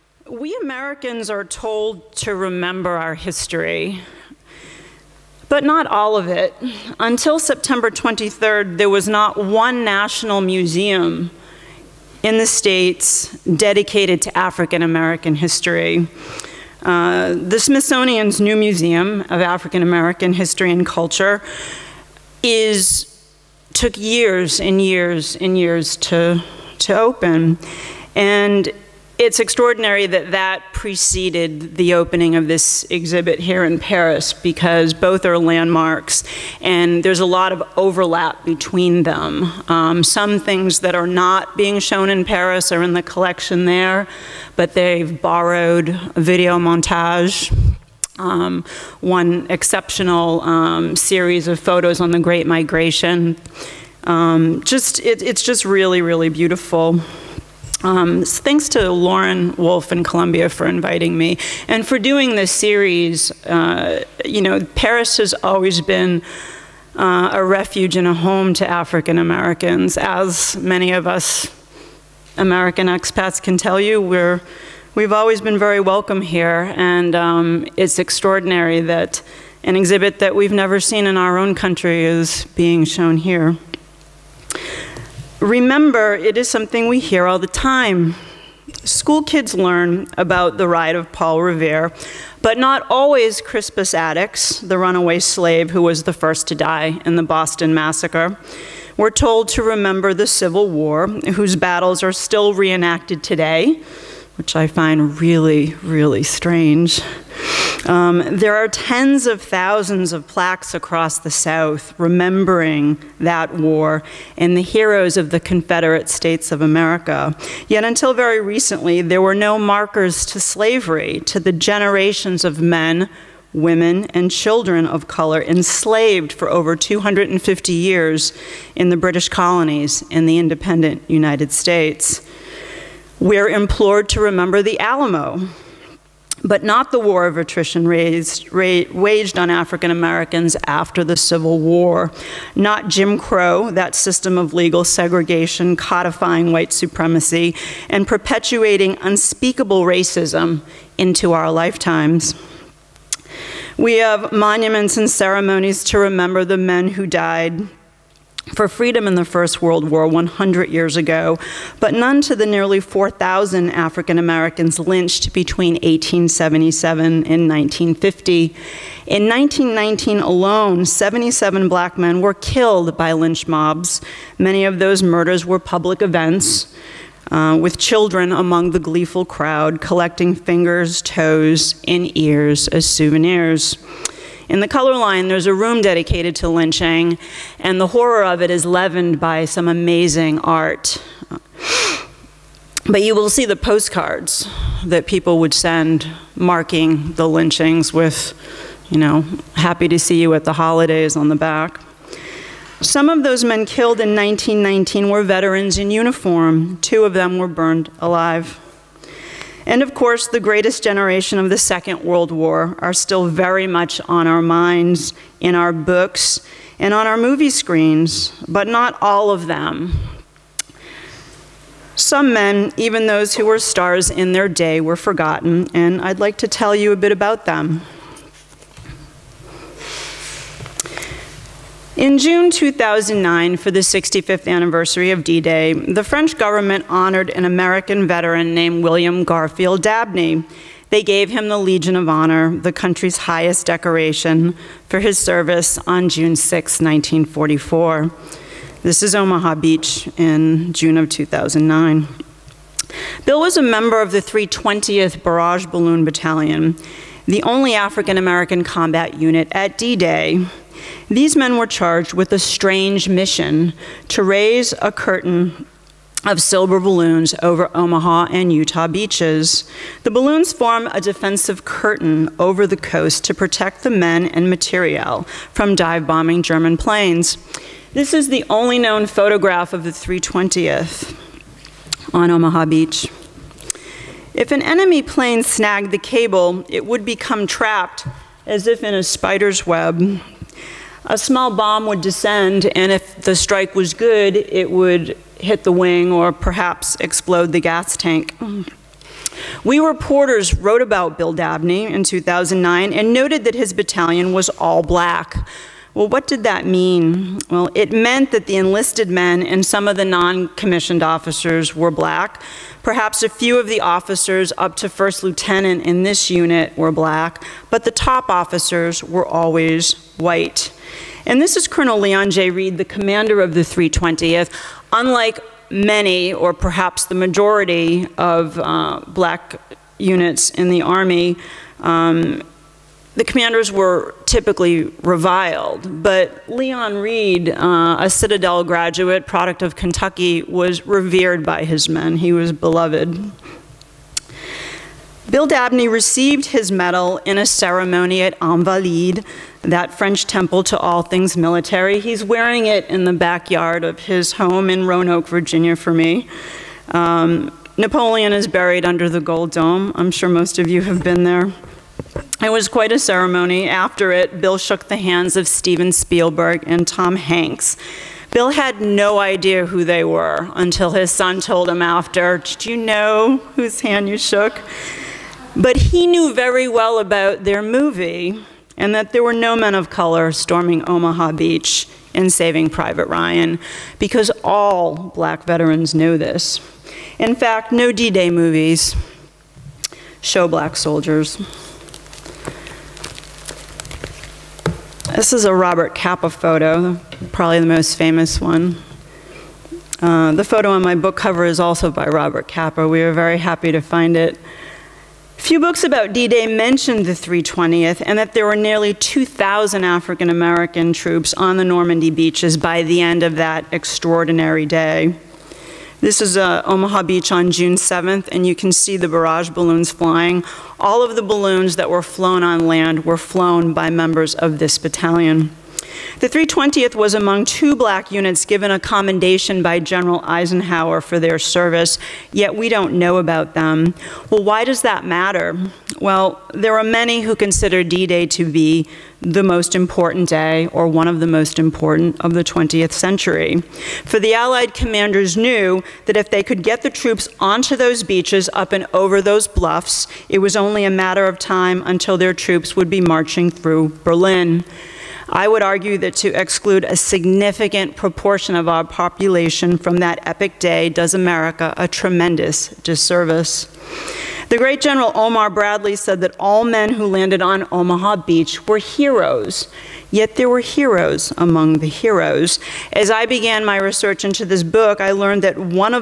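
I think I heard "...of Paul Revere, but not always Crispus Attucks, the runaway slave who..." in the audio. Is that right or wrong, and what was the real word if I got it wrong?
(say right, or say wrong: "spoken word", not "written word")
right.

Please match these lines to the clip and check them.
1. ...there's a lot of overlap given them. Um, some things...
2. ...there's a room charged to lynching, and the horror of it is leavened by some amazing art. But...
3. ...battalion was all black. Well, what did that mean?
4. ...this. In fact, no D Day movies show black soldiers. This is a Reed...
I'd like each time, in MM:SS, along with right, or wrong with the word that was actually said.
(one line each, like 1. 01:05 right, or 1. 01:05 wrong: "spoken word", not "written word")
1. 00:37 wrong: "between", not "given"
2. 03:05 wrong: "dedicated", not "charged"
3. 05:03 right
4. 06:26 wrong: "Robert", not "Reed".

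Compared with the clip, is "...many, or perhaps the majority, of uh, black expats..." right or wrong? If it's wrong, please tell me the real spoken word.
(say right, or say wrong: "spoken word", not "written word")
wrong: "units", not "expats".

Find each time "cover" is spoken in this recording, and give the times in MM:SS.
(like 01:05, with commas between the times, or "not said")
06:41.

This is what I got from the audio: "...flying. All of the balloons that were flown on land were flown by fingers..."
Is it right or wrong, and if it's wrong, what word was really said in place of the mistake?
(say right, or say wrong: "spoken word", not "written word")
wrong: "members", not "fingers".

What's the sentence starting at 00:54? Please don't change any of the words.
Um, just it, it's just really, really beautiful.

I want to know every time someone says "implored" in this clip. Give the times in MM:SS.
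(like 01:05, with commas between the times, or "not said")
02:13.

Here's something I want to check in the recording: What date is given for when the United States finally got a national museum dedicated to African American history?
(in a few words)
September 23rd.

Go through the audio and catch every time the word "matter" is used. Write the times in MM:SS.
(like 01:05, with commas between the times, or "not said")
07:15, 07:30.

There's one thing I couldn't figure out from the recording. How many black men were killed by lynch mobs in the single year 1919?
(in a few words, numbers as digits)
77.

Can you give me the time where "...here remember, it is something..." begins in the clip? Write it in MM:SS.
01:23.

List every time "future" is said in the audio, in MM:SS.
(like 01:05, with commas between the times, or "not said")
not said.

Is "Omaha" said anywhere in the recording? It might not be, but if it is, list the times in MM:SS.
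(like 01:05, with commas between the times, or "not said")
04:09, 04:27, 04:42, 06:20, 06:56, 07:47.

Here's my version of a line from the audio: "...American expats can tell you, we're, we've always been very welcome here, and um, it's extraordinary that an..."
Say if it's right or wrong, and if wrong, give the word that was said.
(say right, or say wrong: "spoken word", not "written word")
right.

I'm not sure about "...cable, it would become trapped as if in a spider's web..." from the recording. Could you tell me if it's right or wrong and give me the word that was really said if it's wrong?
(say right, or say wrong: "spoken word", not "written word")
right.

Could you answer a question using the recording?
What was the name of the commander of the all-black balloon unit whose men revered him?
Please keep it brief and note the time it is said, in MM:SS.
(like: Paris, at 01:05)
Leon J. 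Reed, at 05:21.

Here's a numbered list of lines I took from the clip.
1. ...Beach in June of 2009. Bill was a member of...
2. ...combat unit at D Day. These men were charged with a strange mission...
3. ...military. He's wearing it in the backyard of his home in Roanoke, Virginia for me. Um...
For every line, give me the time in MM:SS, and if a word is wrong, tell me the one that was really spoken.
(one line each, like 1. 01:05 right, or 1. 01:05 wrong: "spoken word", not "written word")
1. 04:09 right
2. 04:18 right
3. 05:51 right.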